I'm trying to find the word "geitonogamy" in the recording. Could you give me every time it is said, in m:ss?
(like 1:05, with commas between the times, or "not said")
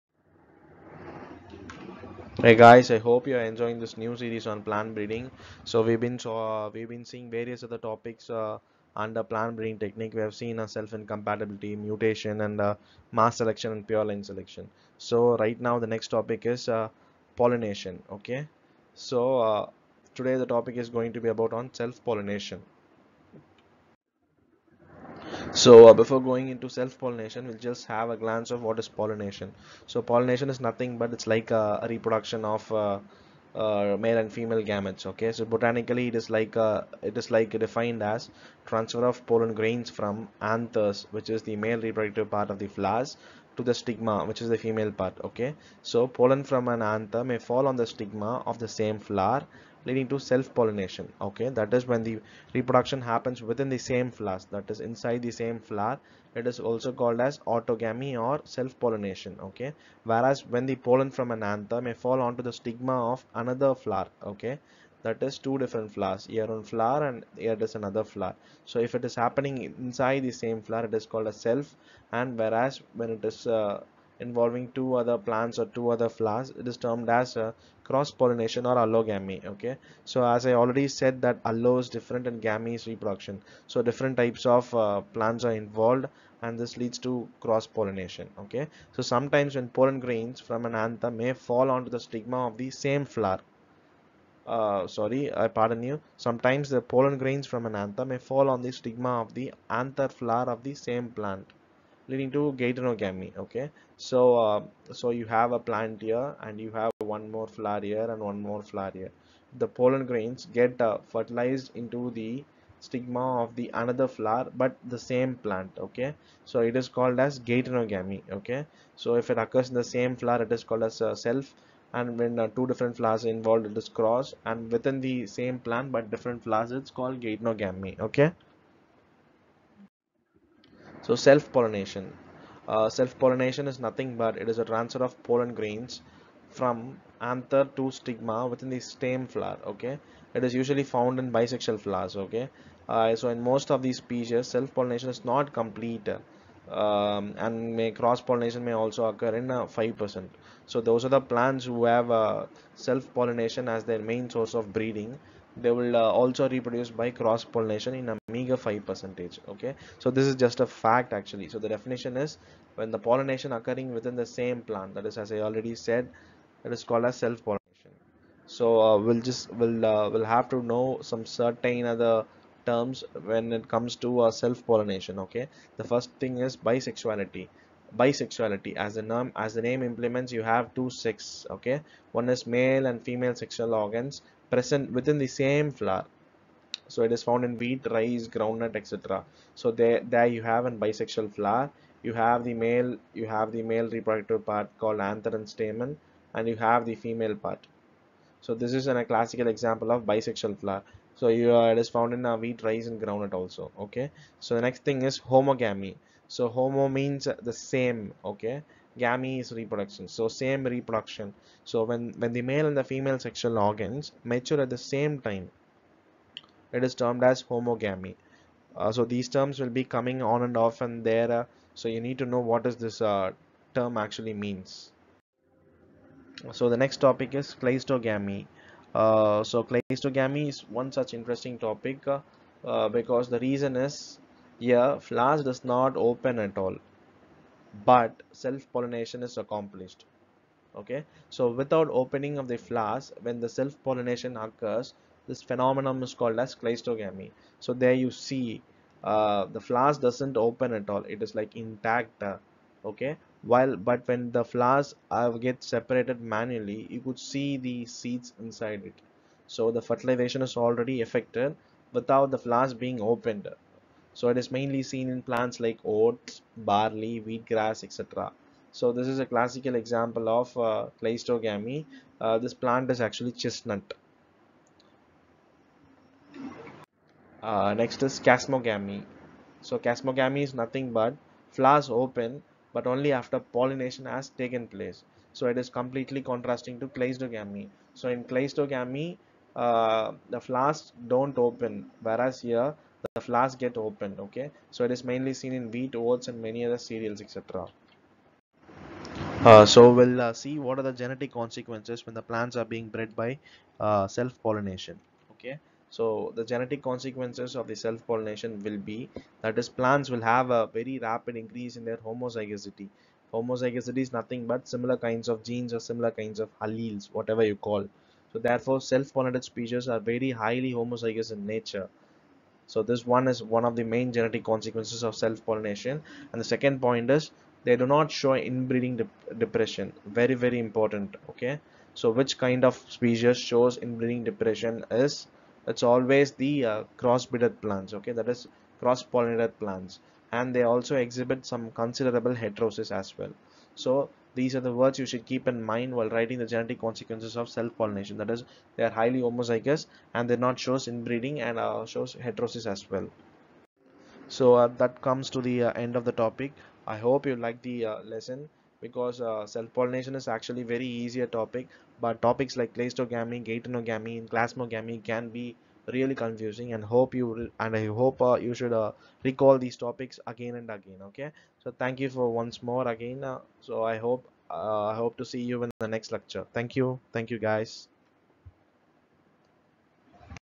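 1:42, 1:57, 2:07, 6:03.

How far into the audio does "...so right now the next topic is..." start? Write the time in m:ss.
0:14.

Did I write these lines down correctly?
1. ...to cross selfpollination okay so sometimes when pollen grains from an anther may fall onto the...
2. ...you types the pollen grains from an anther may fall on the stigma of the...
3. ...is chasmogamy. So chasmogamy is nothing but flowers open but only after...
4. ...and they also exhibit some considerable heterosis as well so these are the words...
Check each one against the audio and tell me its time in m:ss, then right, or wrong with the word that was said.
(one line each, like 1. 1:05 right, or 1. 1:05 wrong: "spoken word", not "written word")
1. 1:27 wrong: "pollination", not "selfpollination"
2. 1:35 wrong: "sometimes", not "types"
3. 4:38 right
4. 5:40 right.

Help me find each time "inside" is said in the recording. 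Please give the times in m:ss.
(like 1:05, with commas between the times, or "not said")
0:54, 1:09, 4:18.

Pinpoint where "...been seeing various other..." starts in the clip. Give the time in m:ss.
0:06.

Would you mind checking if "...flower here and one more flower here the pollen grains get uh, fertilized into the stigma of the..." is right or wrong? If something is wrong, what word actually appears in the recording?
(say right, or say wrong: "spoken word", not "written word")
right.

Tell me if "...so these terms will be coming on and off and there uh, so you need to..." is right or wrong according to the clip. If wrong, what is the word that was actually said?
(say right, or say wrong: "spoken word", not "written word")
right.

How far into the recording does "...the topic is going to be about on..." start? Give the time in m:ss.
0:20.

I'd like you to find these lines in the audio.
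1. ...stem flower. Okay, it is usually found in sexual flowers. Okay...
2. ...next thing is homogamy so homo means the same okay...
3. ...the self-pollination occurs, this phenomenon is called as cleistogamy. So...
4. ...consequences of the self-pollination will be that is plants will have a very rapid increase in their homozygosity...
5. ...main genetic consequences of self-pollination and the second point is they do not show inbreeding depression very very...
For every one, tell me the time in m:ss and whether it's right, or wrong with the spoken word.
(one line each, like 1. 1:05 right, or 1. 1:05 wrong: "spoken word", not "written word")
1. 2:18 wrong: "bisexual", not "sexual"
2. 3:24 right
3. 4:03 right
4. 5:06 right
5. 5:23 right.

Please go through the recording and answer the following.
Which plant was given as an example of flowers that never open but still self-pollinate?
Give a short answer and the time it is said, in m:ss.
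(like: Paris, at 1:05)
Chestnut, at 4:33.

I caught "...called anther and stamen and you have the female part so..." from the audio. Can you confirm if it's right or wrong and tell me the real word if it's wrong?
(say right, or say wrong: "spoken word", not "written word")
right.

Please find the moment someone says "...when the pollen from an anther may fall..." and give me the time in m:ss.
1:00.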